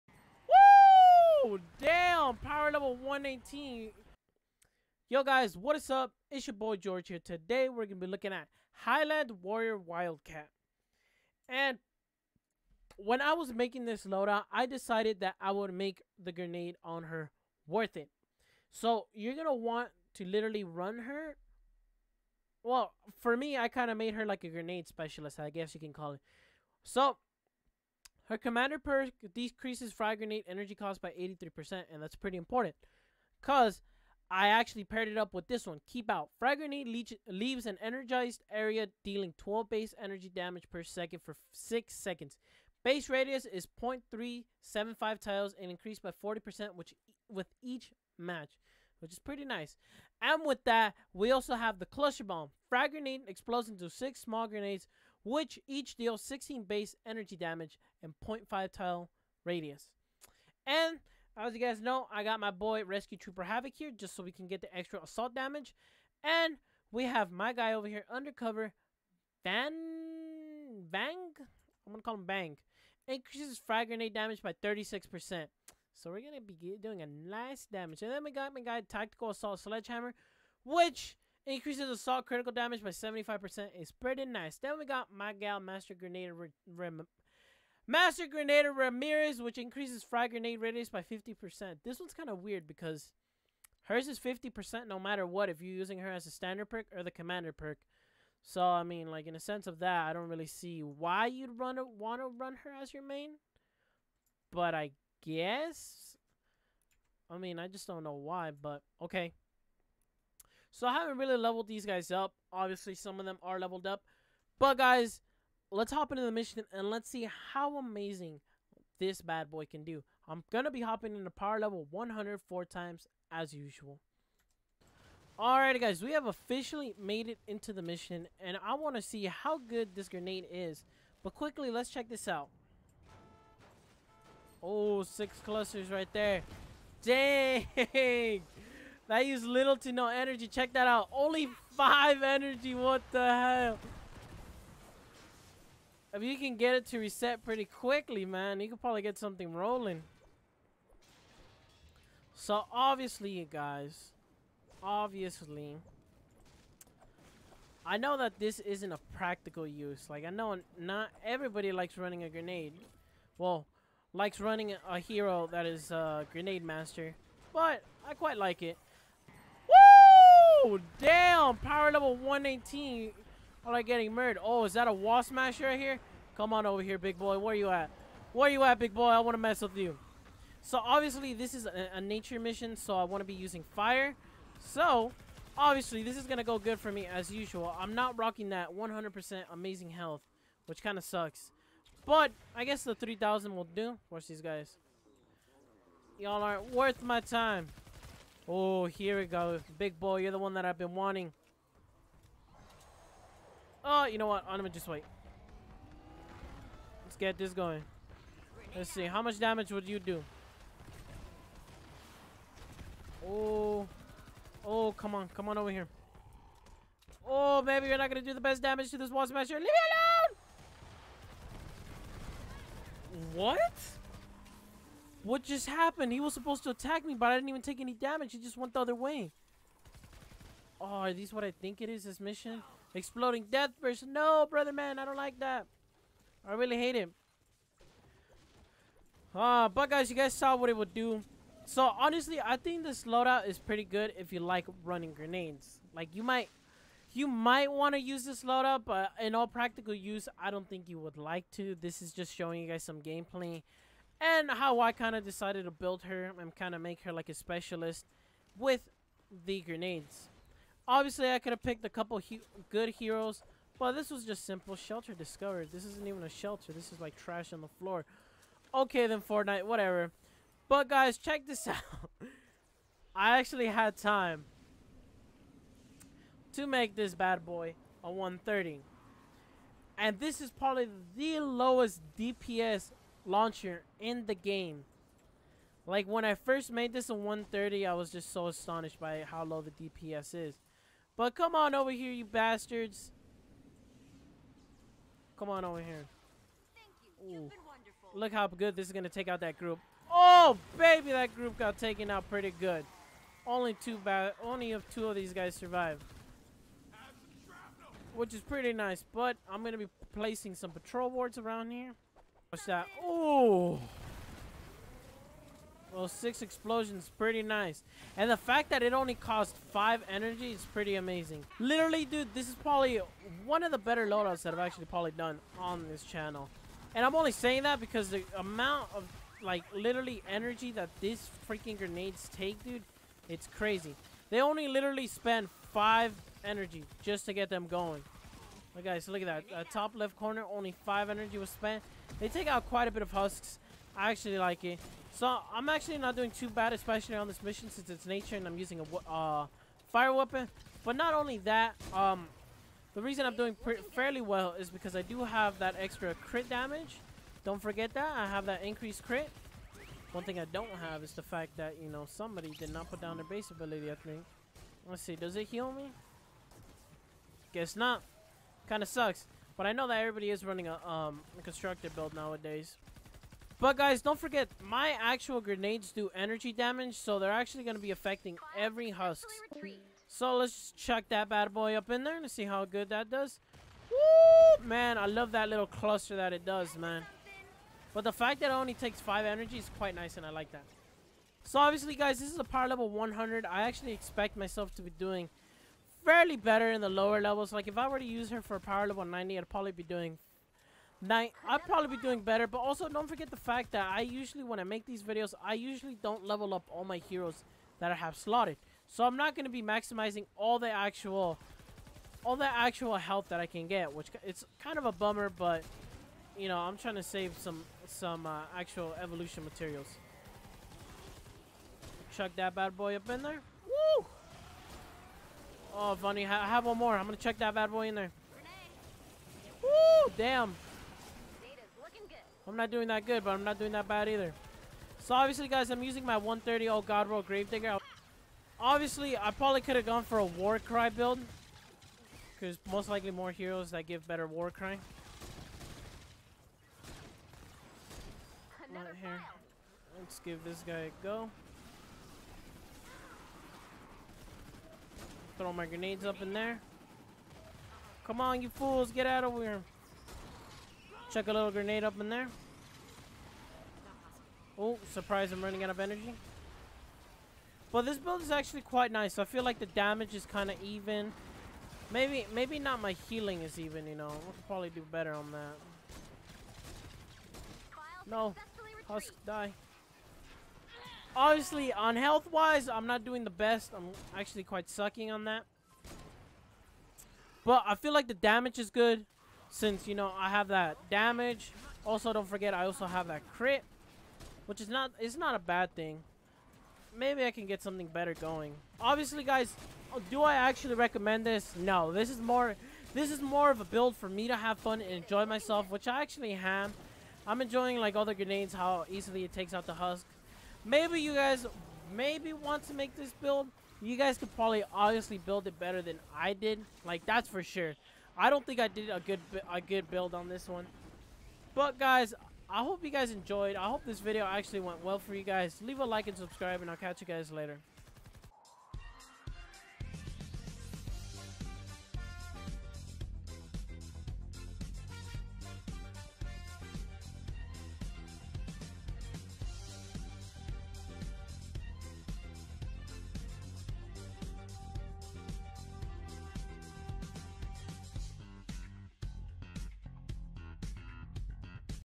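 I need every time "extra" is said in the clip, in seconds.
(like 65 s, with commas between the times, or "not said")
64 s, 355 s.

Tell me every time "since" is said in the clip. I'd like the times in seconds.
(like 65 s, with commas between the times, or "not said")
347 s, 489 s.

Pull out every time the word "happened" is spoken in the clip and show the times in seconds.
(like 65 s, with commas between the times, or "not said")
225 s.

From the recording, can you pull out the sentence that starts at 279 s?
And this is probably the lowest DPS launcher in the game.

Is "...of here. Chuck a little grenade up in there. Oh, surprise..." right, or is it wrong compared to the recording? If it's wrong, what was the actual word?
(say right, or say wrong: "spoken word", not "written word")
right.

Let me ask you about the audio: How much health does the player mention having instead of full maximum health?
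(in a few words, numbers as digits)
3,000.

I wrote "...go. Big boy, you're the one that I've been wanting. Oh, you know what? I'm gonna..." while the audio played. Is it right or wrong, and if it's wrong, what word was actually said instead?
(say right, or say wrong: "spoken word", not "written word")
right.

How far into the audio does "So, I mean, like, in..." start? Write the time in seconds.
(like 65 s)
98 s.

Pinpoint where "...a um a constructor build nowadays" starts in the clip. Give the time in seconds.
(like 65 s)
370 s.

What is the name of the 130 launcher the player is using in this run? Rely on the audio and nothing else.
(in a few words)
Gravedigger.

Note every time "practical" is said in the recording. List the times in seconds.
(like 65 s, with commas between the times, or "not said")
159 s, 249 s.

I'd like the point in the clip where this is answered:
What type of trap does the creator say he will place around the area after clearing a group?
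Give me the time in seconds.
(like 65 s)
310 s.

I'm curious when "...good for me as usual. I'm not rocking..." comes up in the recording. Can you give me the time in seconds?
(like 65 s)
186 s.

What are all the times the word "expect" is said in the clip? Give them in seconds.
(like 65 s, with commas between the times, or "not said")
393 s.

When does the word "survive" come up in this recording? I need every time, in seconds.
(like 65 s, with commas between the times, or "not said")
305 s.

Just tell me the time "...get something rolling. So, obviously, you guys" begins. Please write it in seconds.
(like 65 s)
149 s.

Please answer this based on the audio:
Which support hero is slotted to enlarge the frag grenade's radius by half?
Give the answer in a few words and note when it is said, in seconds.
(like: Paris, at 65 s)
Master Grenade Ramirez, at 87 s.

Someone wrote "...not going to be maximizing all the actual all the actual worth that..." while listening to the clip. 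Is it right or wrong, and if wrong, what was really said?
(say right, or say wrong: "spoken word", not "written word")
wrong: "health", not "worth".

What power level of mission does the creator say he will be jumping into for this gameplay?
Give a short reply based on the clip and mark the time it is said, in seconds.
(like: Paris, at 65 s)
104, at 121 s.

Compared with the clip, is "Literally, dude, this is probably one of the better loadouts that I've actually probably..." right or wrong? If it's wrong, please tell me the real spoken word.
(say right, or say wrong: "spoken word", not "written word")
right.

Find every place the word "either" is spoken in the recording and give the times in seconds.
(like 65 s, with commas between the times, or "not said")
434 s.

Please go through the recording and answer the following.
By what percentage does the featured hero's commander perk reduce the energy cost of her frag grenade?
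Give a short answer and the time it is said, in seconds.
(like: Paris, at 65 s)
83%, at 31 s.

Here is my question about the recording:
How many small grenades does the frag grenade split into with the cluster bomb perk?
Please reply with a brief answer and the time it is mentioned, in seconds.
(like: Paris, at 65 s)
6, at 53 s.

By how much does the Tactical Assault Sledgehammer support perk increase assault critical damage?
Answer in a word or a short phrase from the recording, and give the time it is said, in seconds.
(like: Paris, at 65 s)
75%, at 82 s.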